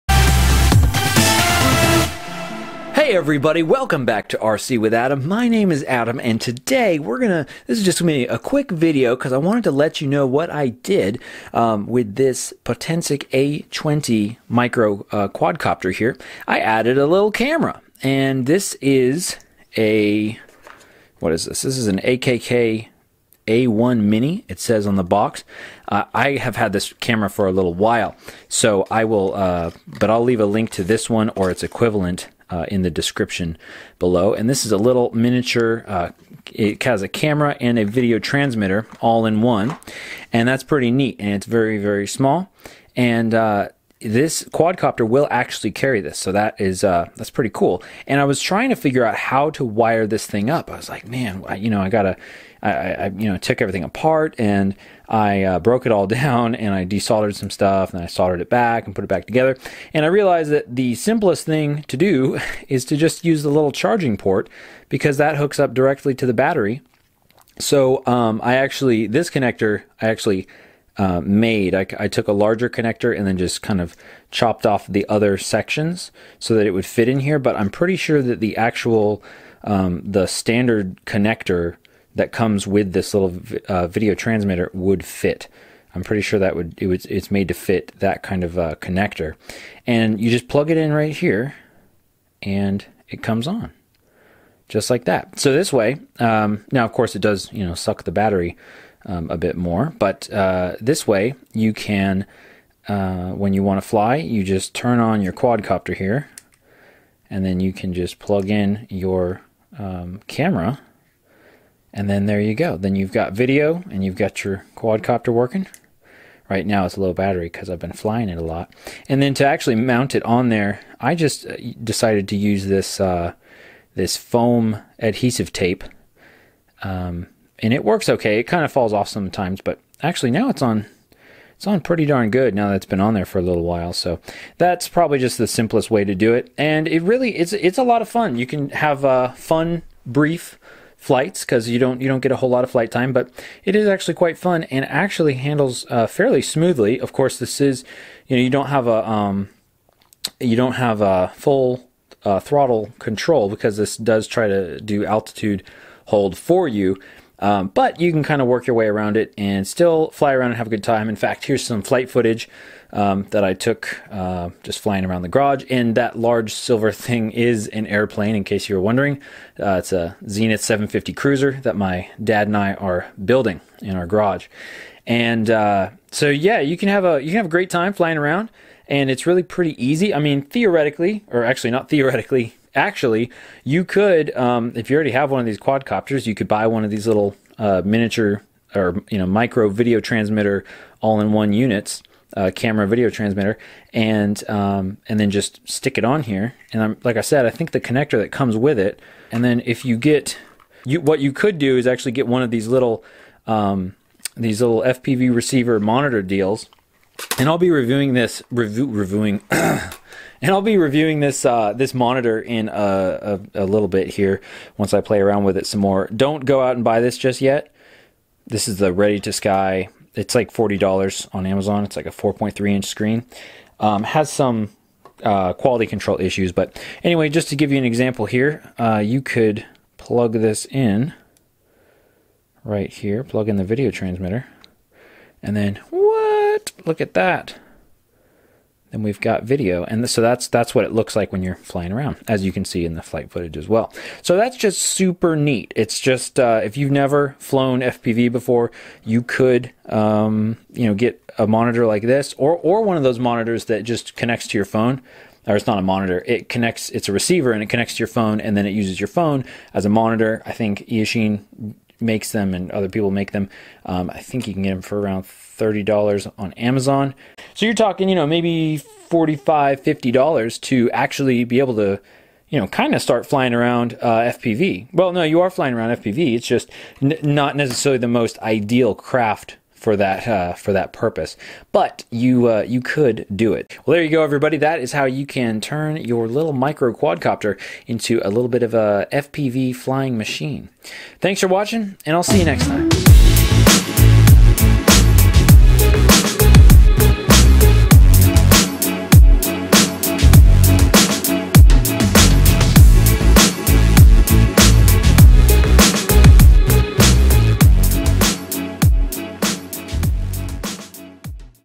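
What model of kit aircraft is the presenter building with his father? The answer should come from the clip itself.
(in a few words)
Zenith 750 Cruzer.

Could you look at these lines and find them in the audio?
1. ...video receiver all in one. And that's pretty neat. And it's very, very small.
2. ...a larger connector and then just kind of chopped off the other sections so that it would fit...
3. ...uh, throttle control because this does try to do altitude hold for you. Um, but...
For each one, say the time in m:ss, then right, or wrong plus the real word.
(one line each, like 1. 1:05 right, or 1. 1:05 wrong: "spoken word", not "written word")
1. 0:37 wrong: "transmitter", not "receiver"
2. 1:12 right
3. 2:32 right.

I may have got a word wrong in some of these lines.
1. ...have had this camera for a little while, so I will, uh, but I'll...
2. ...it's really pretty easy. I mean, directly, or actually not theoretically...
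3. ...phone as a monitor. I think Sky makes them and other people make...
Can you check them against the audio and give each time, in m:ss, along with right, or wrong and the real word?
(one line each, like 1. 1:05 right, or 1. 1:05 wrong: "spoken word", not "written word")
1. 0:26 right
2. 2:59 wrong: "theoretically", not "directly"
3. 4:19 wrong: "Eachine", not "Sky".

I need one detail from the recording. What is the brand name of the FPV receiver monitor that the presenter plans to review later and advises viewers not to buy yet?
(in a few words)
Ready to Sky.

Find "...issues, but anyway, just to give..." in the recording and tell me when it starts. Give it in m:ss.
3:46.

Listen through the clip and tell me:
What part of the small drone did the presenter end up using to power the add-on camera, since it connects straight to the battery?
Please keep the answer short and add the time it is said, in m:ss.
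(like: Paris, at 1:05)
charging port, at 1:03.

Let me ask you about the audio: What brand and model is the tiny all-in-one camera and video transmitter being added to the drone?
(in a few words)
AKK A1 Mini.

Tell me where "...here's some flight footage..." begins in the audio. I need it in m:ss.
2:41.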